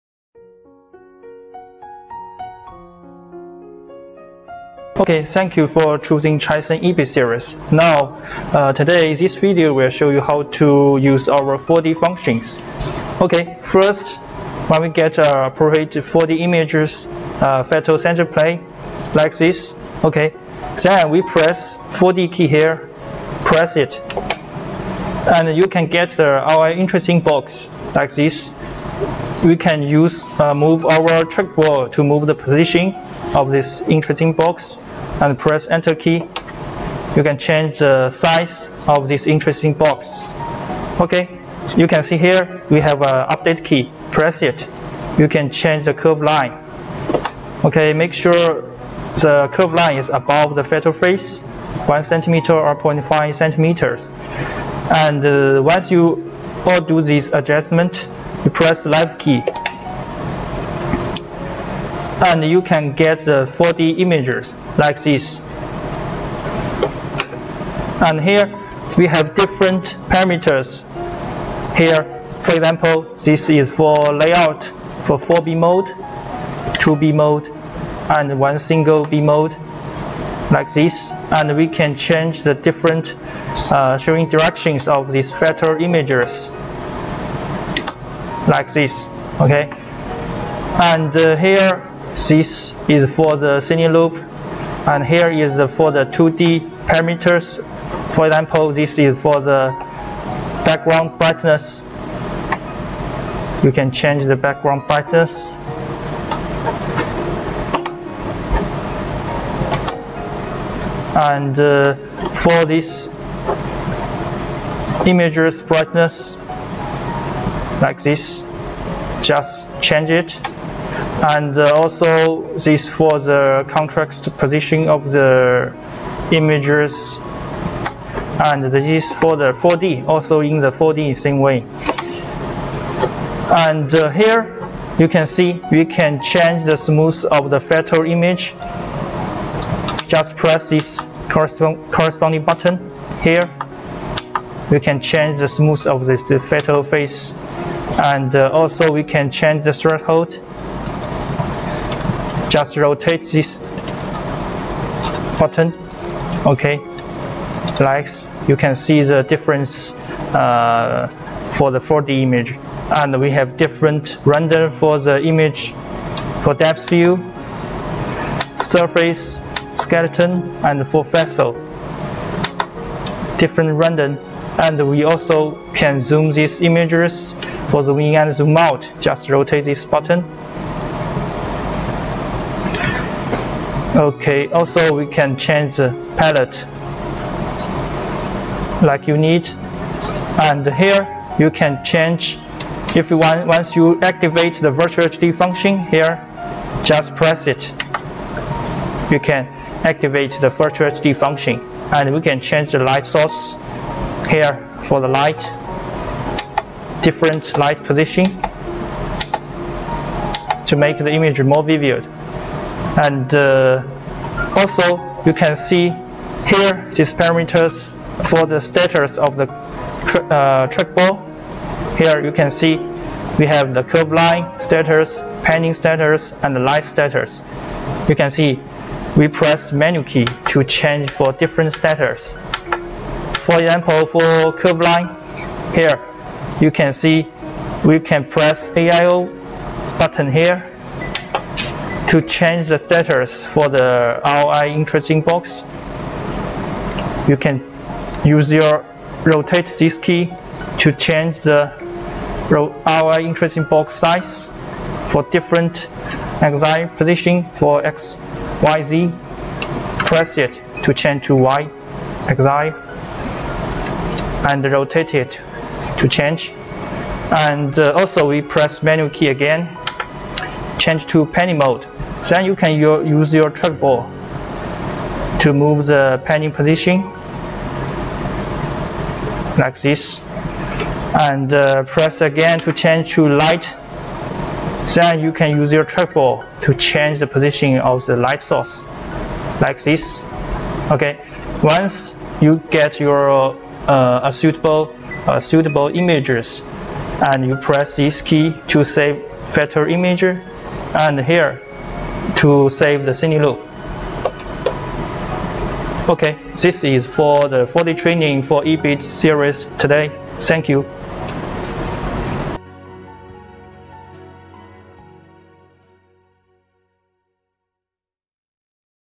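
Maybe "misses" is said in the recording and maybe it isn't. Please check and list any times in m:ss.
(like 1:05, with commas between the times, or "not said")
not said.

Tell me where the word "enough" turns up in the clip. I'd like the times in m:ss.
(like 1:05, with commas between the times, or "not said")
not said.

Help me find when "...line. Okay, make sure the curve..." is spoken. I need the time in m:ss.
0:46.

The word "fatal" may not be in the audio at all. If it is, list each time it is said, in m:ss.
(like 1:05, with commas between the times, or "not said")
0:50, 2:26.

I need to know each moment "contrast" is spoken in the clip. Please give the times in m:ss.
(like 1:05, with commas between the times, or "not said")
2:03.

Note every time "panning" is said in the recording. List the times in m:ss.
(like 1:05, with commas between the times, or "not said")
3:45, 4:31, 4:36.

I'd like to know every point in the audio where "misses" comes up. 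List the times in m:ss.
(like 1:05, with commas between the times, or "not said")
not said.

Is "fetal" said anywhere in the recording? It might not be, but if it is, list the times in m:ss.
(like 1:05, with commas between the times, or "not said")
0:17, 2:17.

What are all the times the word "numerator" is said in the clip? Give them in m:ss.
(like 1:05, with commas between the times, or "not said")
not said.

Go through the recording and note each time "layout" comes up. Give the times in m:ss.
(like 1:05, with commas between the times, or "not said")
1:14.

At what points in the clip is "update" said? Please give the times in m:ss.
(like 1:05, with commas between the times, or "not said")
0:43.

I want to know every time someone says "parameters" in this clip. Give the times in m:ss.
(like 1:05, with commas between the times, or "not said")
1:10, 1:36, 3:37.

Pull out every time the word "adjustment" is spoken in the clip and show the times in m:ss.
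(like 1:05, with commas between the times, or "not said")
0:57.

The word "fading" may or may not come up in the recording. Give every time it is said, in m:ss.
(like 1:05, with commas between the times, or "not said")
not said.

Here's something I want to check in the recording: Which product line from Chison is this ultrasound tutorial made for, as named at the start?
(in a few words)
EB series.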